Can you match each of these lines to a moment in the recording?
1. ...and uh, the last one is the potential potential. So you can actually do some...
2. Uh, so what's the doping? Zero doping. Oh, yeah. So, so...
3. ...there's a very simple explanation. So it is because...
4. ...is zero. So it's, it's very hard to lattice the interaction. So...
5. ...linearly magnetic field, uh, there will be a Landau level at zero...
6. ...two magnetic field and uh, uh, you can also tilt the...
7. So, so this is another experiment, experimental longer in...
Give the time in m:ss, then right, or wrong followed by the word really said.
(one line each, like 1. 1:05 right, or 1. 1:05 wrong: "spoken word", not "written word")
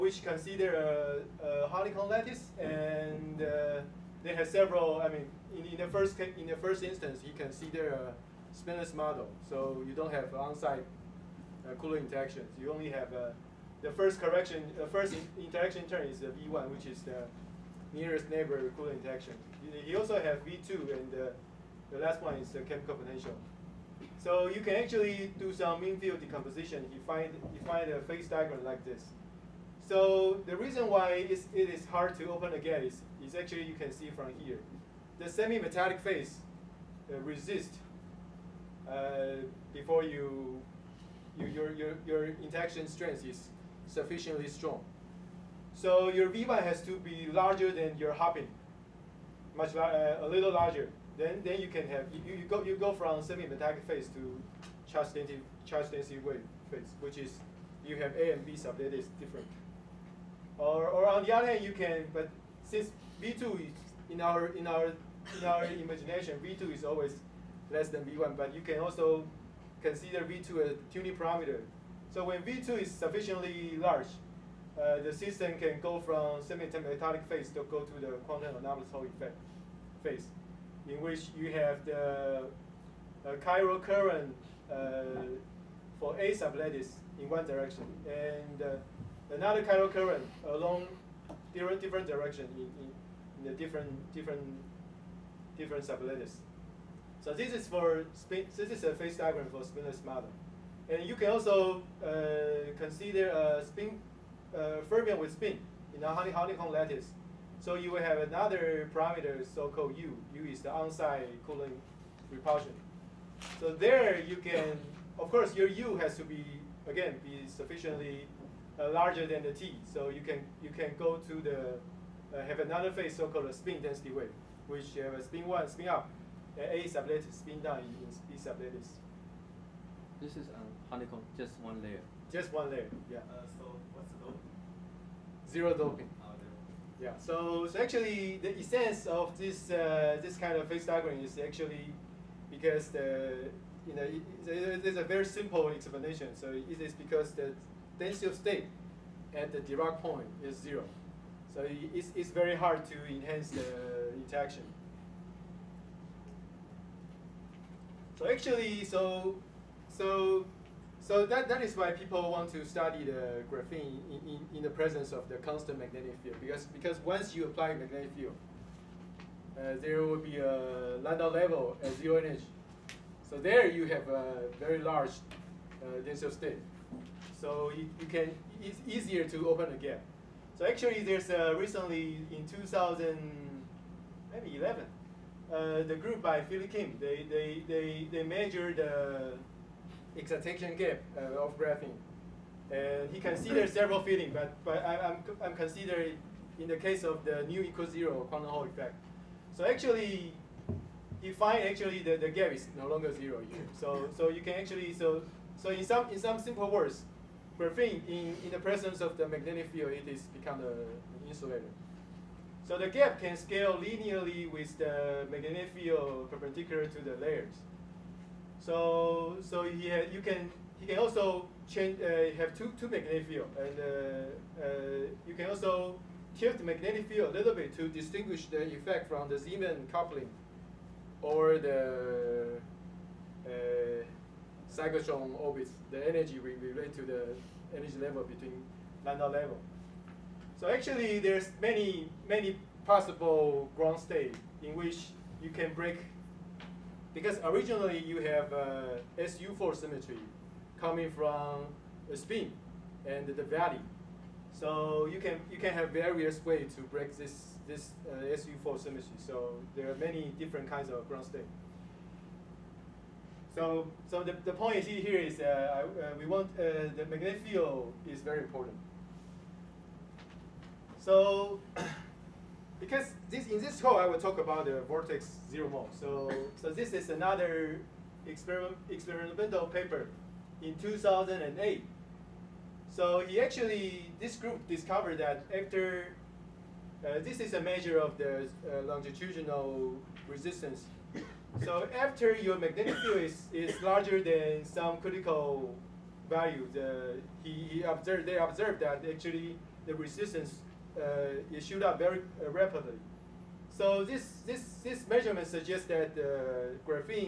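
1. 0:20 wrong: "chemical", not "potential"
2. 2:13 right
3. 2:24 right
4. 2:30 wrong: "enhance", not "lattice"
5. 2:47 wrong: "apply", not "linearly"
6. 3:42 right
7. 4:36 wrong: "paper", not "longer".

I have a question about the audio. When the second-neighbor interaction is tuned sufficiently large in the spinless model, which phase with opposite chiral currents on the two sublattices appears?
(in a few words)
Quantum anomalous Hall effect phase.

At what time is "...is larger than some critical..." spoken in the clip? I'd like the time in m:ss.
4:53.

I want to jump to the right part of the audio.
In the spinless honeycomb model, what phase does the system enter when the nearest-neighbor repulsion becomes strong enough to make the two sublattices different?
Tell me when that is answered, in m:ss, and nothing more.
0:54.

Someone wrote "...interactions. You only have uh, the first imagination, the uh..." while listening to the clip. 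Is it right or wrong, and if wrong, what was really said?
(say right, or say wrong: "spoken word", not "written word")
wrong: "correction", not "imagination".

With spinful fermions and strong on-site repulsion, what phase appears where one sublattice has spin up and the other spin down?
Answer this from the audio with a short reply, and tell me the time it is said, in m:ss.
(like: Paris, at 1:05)
Spin density wave, at 2:03.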